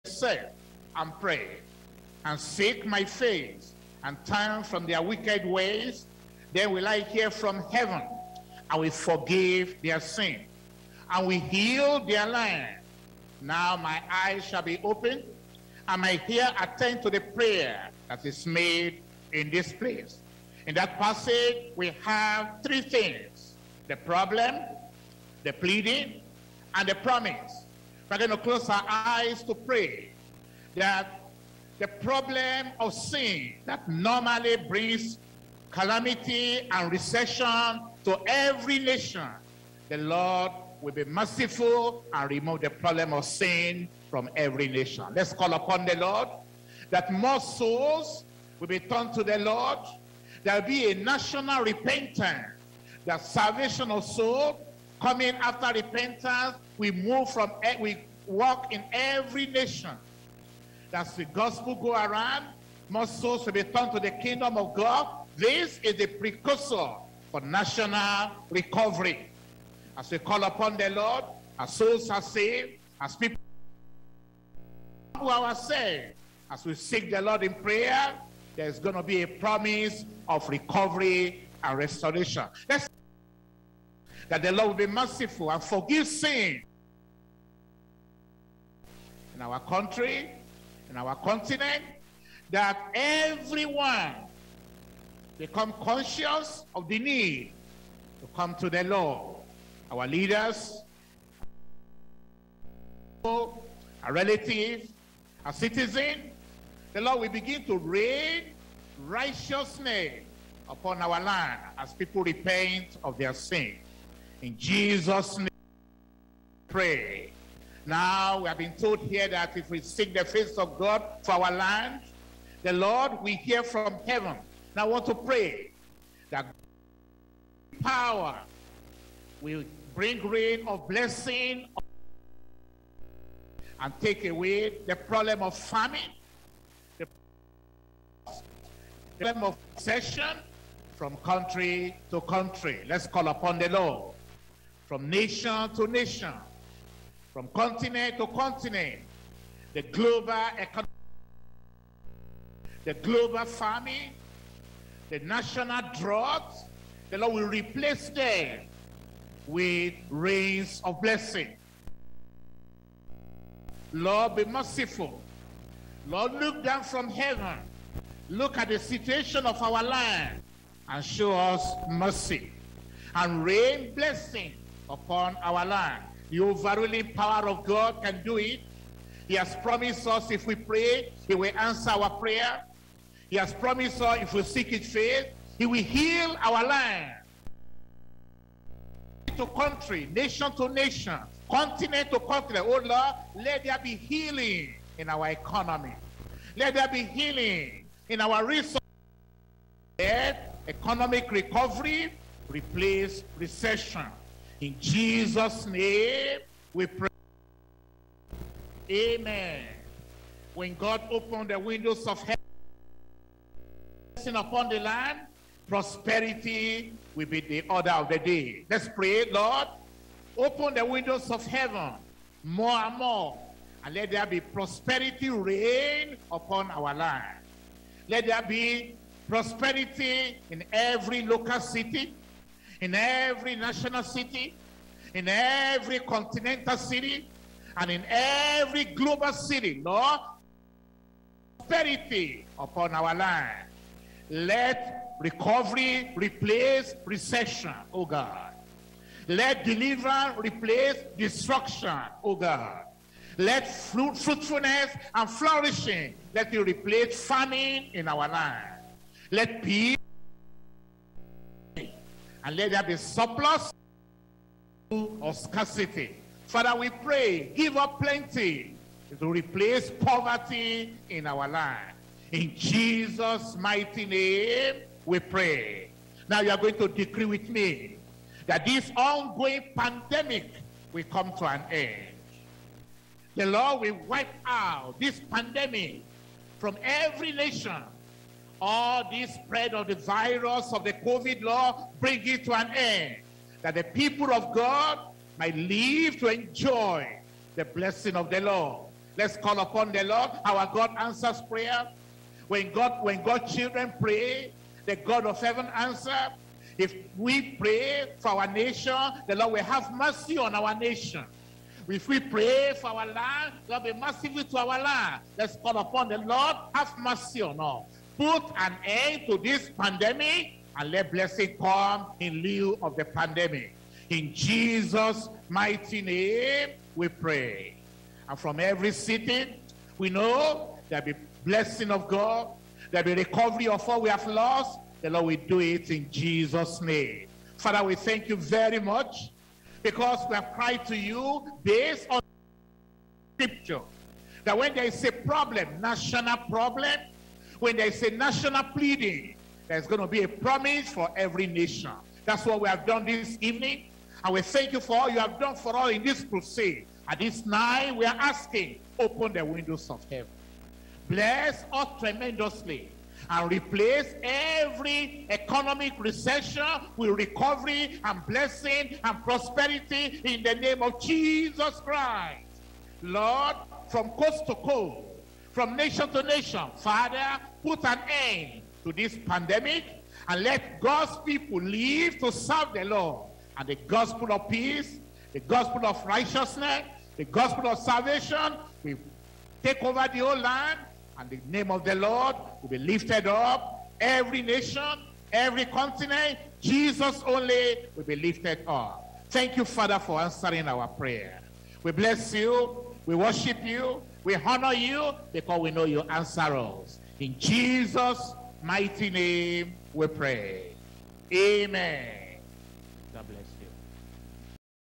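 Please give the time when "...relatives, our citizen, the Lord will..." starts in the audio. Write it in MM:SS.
01:44.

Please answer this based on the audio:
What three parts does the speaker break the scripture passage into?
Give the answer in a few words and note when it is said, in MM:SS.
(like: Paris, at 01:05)
the problem, the pleading, and the promise, at 00:23.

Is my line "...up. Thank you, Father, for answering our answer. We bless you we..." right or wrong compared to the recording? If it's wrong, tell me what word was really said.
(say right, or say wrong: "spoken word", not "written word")
wrong: "prayer", not "answer".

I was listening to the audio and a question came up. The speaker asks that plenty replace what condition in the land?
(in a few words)
poverty.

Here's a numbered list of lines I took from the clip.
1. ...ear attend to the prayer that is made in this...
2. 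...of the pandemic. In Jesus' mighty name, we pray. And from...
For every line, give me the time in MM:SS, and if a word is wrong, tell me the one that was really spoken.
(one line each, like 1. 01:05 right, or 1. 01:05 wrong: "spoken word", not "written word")
1. 00:16 right
2. 05:22 right.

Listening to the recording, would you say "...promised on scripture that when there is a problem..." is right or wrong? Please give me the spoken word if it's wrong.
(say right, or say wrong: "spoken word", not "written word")
wrong: "based", not "promised".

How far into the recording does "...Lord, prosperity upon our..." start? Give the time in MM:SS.
03:59.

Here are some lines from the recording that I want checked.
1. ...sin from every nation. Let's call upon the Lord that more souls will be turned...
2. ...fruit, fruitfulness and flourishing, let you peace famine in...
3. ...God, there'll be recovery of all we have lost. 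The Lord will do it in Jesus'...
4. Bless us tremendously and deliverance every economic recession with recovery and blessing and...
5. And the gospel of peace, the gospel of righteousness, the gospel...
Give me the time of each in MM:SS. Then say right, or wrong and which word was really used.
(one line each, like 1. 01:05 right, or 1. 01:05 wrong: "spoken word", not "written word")
1. 00:43 right
2. 04:13 wrong: "replace", not "peace"
3. 05:32 right
4. 06:01 wrong: "replace", not "deliverance"
5. 06:23 right.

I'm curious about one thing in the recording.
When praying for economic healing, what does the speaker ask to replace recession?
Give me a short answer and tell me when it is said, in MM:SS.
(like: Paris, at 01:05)
economic recovery, at 03:20.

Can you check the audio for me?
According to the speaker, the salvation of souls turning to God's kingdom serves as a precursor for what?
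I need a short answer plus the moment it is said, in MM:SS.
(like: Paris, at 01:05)
national recovery, at 01:07.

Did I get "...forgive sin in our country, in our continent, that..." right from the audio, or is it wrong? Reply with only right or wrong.
right.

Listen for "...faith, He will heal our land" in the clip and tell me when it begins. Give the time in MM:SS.
03:04.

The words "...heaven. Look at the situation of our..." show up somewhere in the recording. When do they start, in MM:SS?
02:47.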